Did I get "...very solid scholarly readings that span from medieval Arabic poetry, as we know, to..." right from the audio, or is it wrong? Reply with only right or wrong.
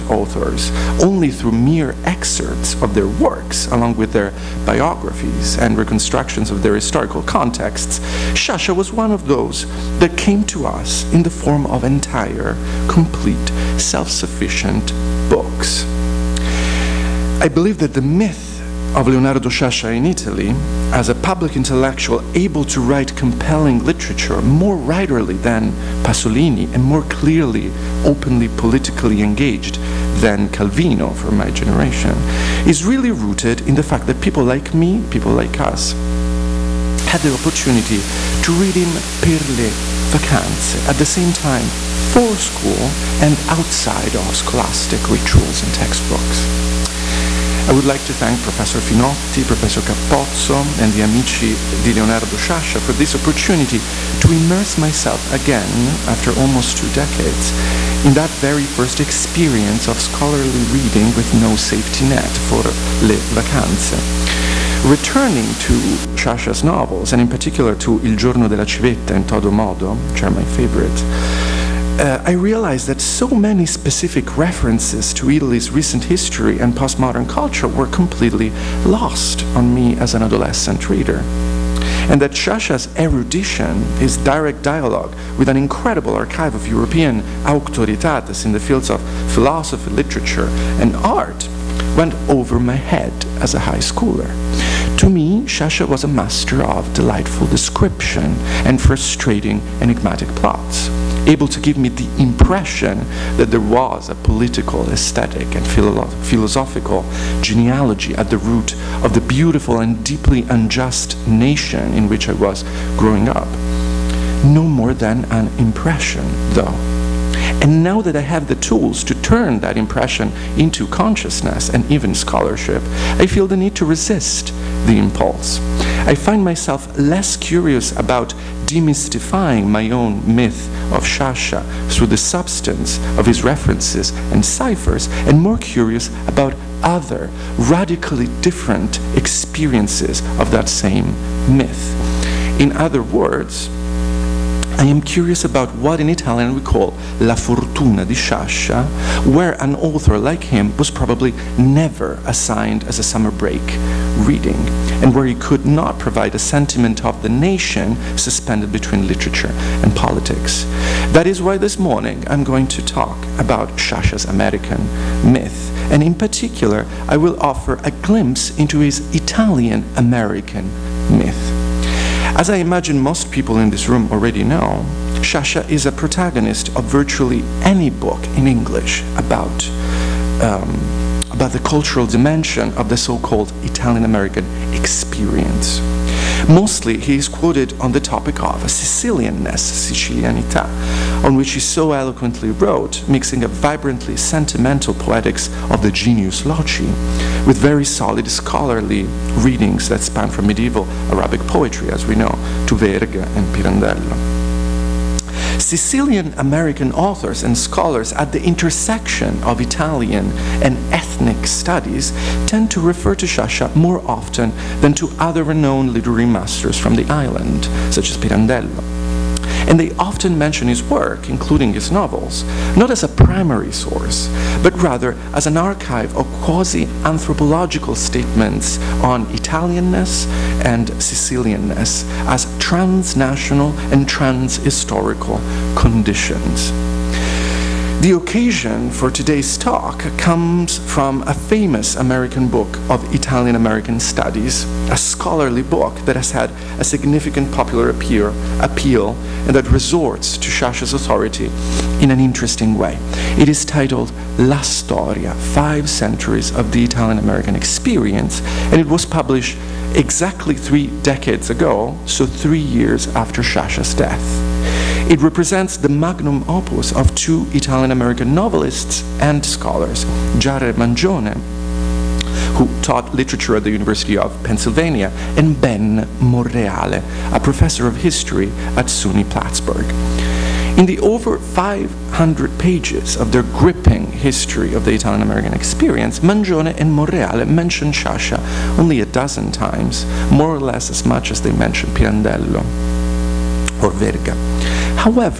right.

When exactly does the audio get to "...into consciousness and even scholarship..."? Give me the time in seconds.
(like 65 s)
120 s.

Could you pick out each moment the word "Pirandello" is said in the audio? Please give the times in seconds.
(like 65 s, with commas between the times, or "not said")
203 s, 218 s, 291 s.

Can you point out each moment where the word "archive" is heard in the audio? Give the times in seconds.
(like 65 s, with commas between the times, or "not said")
86 s, 225 s.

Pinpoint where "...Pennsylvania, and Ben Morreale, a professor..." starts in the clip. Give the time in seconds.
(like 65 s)
274 s.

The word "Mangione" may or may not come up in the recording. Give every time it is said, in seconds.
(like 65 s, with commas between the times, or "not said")
270 s, 286 s.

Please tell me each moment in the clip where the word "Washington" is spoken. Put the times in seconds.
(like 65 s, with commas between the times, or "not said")
not said.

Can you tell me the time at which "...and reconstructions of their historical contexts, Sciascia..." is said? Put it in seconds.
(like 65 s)
5 s.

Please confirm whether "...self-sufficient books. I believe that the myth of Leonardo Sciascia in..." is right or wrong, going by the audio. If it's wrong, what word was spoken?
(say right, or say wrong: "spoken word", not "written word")
right.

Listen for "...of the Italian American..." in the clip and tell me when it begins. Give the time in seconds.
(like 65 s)
284 s.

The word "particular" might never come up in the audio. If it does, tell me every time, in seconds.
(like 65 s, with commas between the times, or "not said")
67 s, 166 s.